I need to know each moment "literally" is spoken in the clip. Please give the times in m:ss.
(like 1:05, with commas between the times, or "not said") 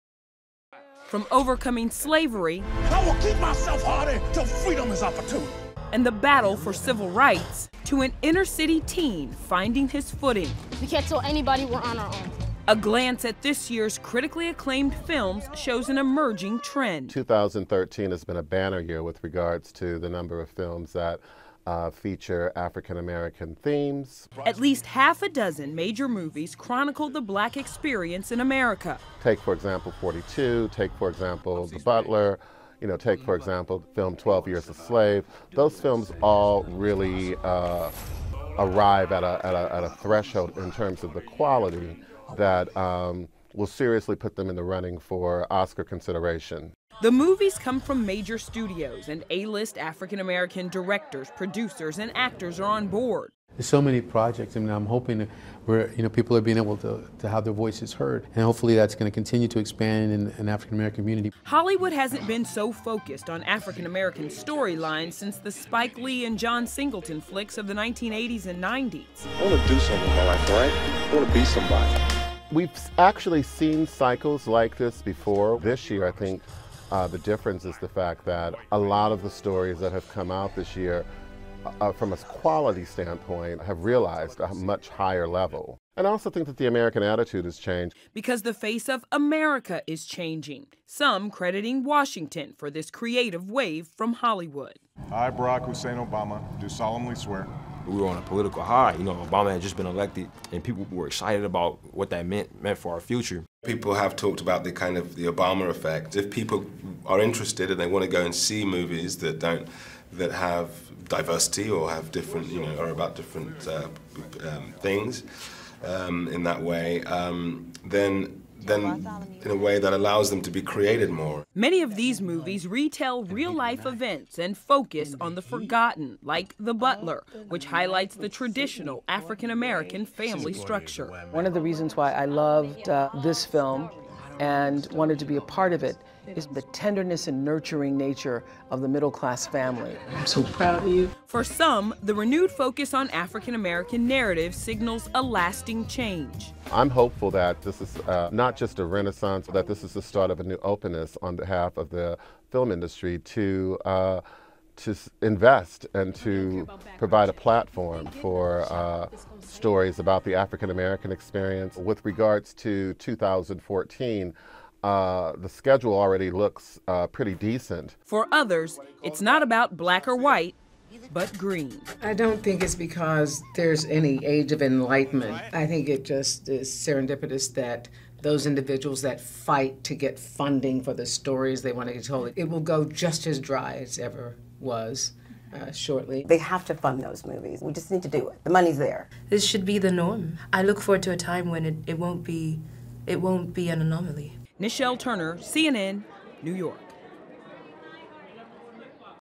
not said.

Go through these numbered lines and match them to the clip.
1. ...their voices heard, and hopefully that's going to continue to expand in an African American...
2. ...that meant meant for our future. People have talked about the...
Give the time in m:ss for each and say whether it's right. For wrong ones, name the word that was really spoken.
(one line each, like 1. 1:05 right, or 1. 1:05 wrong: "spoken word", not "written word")
1. 0:57 right
2. 1:42 right.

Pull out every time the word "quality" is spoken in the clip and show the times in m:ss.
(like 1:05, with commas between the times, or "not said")
0:41, 1:22.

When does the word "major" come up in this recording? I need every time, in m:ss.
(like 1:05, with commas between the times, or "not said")
0:25, 0:48.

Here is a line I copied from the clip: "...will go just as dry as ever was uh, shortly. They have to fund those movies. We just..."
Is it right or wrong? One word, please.
right.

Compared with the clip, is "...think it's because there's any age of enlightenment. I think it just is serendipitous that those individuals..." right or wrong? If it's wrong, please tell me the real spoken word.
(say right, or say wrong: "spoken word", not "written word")
right.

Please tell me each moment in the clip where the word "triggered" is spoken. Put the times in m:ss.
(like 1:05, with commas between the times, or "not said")
not said.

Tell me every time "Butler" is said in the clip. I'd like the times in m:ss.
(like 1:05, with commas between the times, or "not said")
0:31, 2:06.